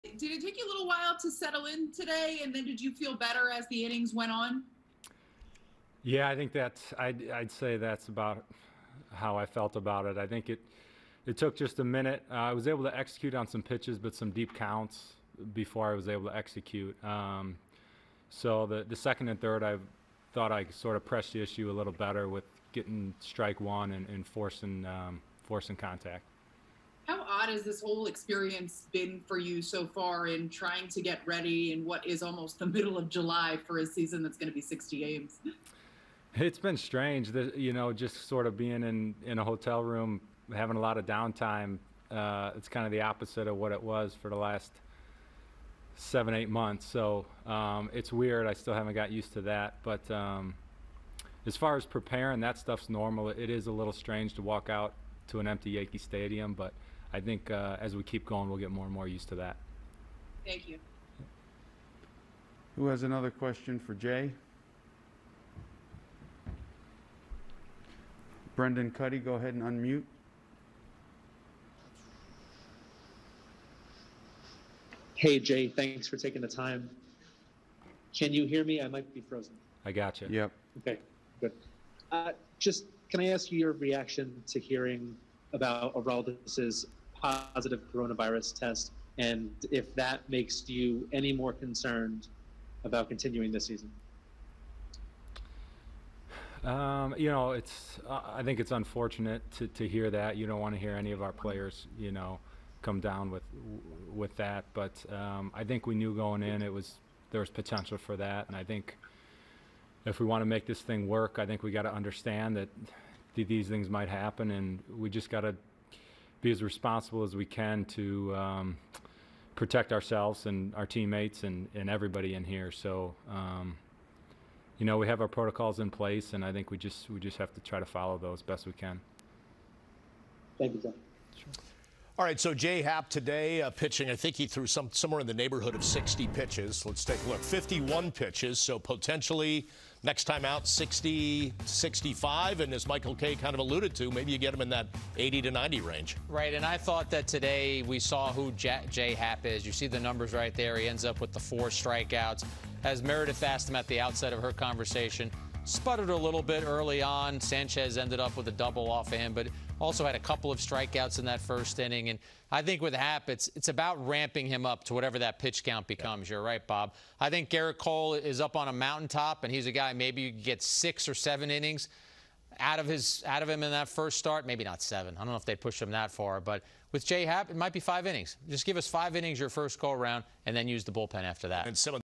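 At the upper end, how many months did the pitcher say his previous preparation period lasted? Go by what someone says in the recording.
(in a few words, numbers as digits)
8.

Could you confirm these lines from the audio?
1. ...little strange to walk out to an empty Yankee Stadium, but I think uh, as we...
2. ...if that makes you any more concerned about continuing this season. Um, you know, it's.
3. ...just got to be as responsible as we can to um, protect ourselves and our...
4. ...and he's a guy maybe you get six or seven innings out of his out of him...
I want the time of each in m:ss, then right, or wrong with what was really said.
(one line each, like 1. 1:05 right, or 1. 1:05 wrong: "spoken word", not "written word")
1. 0:53 right
2. 1:29 right
3. 1:55 right
4. 2:49 right.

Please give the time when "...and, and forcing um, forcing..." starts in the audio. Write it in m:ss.
0:23.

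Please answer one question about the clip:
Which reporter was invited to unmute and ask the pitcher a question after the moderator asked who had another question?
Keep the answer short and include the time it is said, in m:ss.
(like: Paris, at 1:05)
Brendan Kuty, at 1:08.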